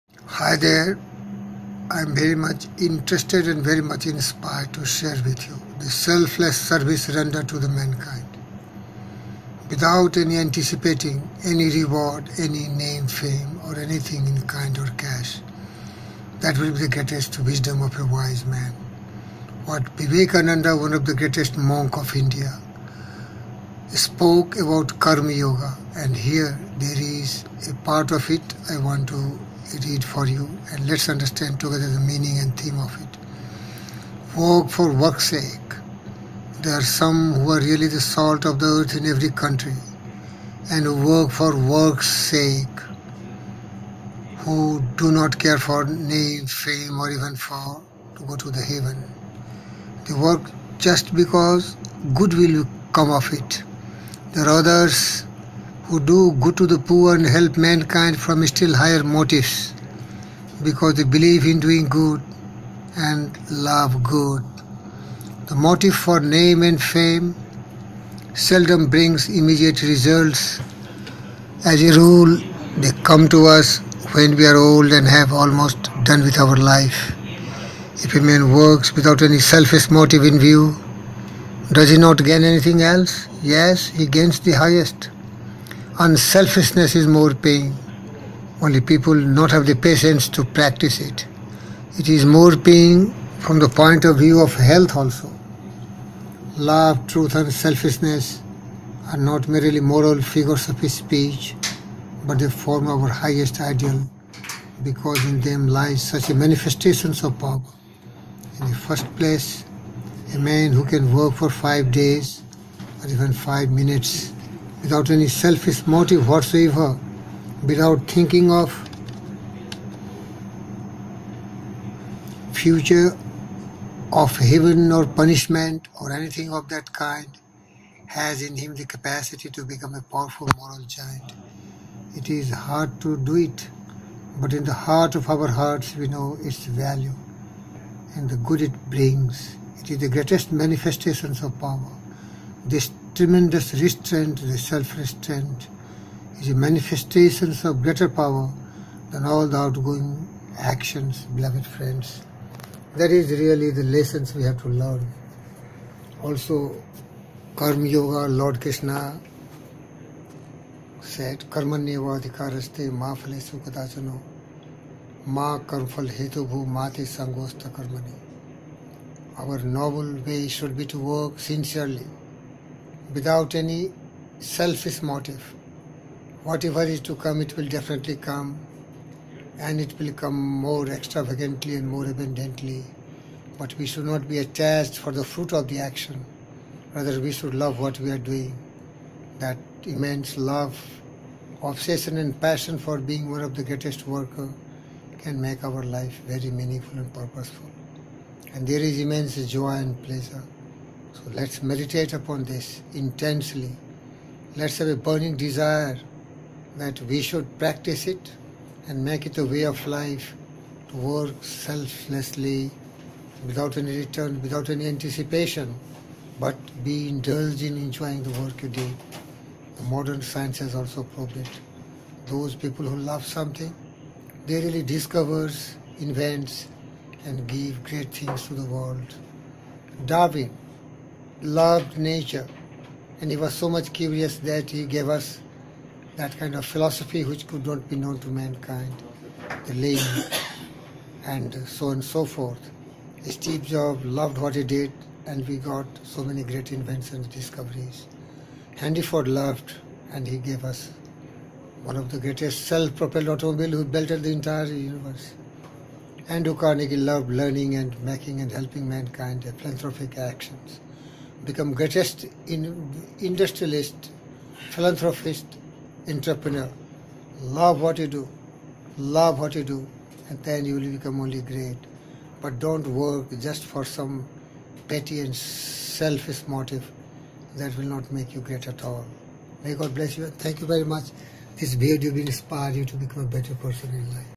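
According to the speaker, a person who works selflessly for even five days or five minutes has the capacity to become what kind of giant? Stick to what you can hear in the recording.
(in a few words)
Moral giant.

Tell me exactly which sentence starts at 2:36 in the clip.
Also, Karma Yoga, Lord Krishna said, Karmanyeva adhikaraste ma phalesu kadachano ma karmphal hetubhu mate sangosta karmani.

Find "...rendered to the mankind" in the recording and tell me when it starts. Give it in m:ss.
0:07.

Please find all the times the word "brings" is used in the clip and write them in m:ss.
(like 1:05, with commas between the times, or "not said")
1:08, 2:18.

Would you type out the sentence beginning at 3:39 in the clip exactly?
The modern science has also proved it.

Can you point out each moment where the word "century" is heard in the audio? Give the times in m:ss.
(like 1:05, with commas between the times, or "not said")
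not said.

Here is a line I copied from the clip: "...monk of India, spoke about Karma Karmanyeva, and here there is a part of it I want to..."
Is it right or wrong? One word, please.
wrong.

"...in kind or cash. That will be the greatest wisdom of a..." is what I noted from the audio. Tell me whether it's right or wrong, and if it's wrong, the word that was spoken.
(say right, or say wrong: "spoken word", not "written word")
right.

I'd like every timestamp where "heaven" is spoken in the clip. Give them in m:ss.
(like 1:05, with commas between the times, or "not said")
0:48, 2:04.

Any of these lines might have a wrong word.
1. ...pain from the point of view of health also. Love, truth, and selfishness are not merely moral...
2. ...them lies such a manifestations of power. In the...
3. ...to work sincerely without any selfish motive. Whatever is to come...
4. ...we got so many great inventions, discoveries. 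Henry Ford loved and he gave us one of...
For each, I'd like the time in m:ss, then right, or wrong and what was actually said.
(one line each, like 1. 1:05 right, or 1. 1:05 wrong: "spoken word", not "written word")
1. 1:32 right
2. 1:45 right
3. 2:50 right
4. 4:05 right.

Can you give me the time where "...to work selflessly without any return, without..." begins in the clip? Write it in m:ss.
3:30.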